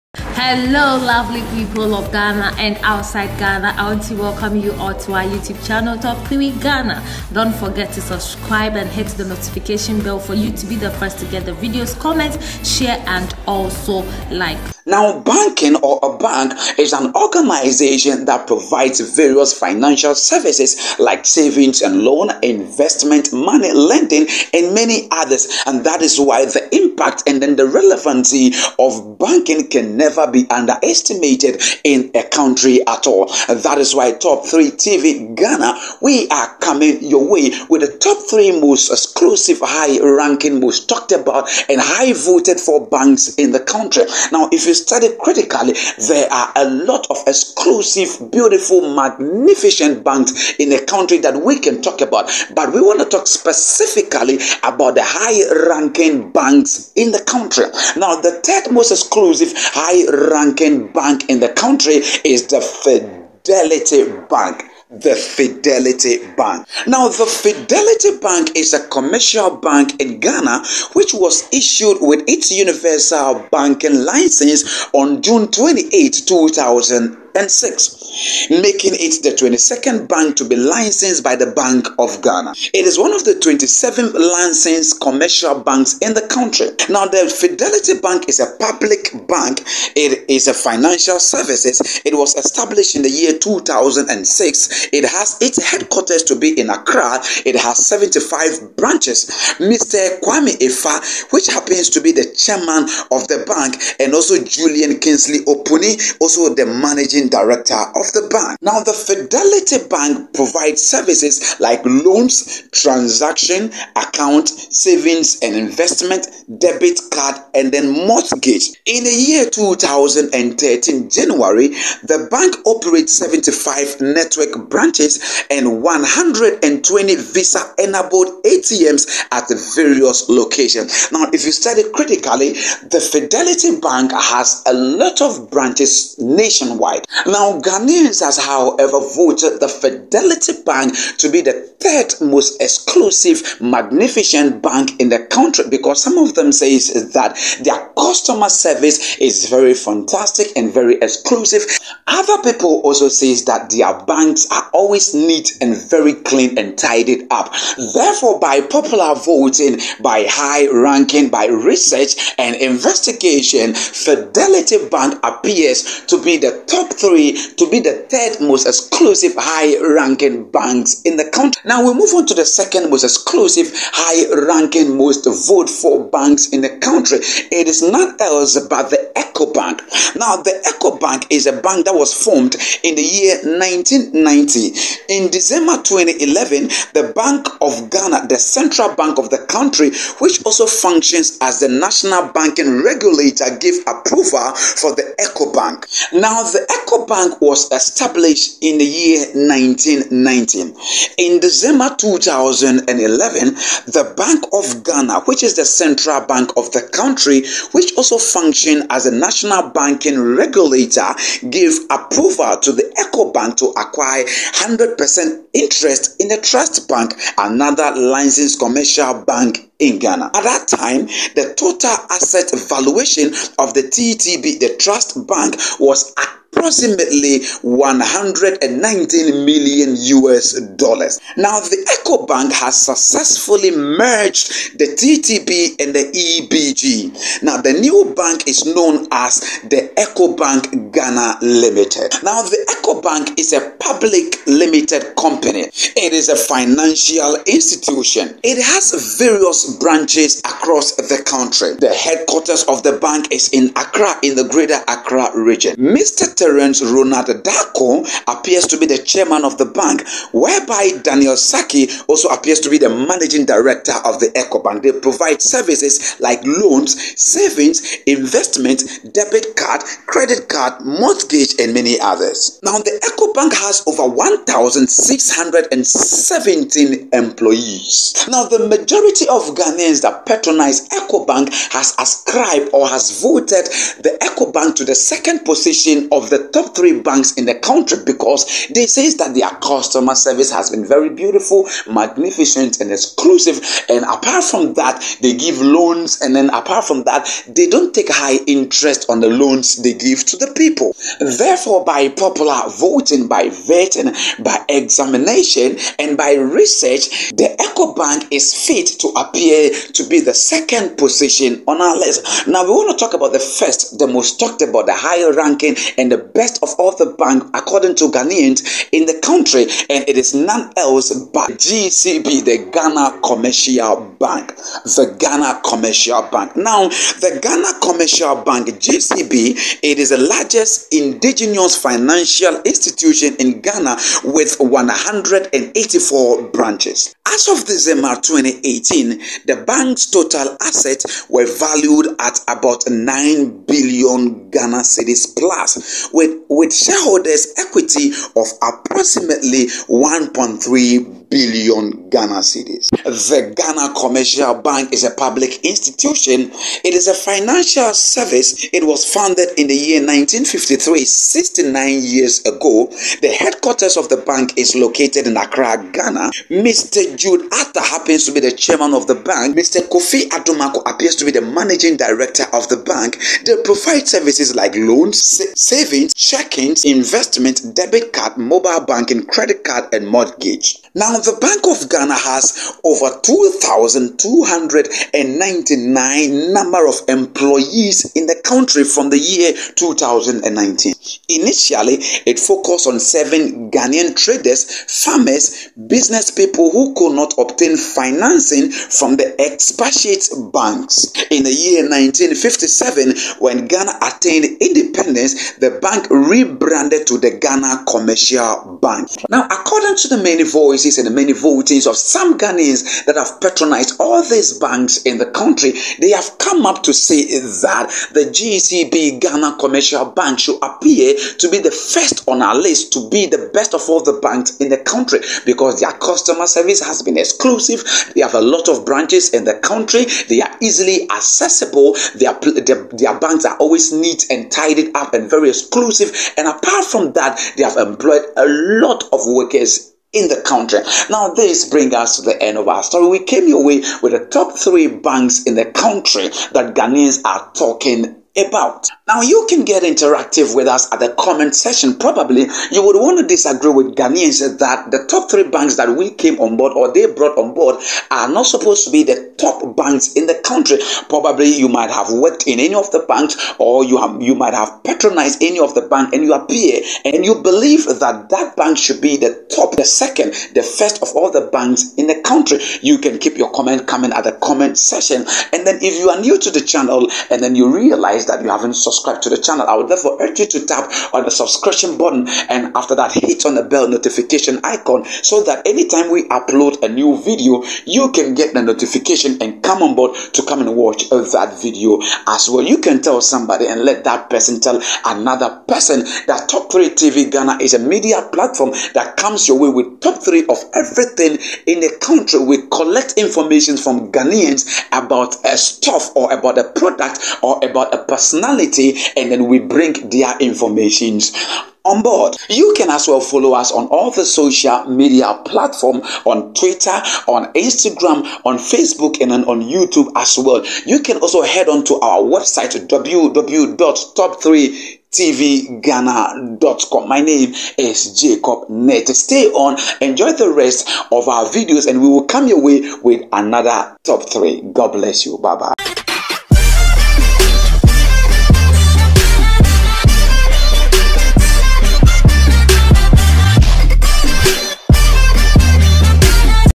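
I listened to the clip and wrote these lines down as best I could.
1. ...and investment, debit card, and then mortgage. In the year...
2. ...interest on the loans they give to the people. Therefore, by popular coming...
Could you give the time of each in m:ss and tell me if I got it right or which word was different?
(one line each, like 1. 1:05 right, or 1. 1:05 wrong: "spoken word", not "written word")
1. 1:55 right
2. 4:58 wrong: "voting", not "coming".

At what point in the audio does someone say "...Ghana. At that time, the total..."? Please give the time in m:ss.
3:39.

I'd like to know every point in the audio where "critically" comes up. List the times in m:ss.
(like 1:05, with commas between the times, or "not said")
0:45, 2:11.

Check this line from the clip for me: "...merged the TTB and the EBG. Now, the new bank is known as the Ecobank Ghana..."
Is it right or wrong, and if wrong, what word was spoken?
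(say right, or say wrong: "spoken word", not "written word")
right.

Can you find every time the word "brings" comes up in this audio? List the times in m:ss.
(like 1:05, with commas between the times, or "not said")
7:21, 8:29.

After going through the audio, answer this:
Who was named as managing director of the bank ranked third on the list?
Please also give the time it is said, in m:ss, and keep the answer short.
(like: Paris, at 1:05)
Julian Kingsley Opuni, at 1:44.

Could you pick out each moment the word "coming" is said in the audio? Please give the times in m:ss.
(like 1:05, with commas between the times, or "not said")
0:36, 7:53.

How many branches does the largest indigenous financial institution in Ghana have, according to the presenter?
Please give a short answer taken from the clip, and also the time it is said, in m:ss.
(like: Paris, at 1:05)
184, at 5:34.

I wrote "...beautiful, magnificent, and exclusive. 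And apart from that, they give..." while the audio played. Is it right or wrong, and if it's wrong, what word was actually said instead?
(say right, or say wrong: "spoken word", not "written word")
right.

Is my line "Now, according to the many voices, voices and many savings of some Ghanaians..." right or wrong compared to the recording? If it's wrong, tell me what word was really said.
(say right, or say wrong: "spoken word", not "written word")
wrong: "votings", not "savings".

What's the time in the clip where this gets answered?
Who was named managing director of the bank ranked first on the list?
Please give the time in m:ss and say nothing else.
6:09.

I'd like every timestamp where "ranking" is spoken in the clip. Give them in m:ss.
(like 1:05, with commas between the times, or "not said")
0:39, 0:55, 1:00, 2:40, 2:49, 2:53, 5:15.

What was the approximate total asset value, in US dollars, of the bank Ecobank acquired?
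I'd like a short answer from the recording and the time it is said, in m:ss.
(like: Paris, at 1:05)
119 million US dollars, at 3:47.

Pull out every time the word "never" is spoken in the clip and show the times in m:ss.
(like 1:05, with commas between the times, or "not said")
0:29.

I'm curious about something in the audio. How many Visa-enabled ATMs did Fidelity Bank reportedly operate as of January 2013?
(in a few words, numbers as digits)
120.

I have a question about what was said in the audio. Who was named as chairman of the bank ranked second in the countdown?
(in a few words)
Terence Ronald Darko.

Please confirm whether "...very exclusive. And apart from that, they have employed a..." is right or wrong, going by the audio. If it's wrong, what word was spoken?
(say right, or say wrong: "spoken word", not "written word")
right.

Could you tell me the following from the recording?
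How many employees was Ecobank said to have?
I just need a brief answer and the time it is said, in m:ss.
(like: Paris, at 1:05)
1,617, at 4:34.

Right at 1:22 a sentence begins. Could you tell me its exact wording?
It is one of the 27 licensed commercial banks in the country.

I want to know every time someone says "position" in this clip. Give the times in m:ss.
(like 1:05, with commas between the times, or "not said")
4:45, 5:10.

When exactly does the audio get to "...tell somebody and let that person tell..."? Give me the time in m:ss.
8:13.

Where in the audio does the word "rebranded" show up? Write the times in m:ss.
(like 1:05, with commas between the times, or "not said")
6:46.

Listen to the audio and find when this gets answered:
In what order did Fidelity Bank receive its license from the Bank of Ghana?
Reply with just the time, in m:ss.
1:19.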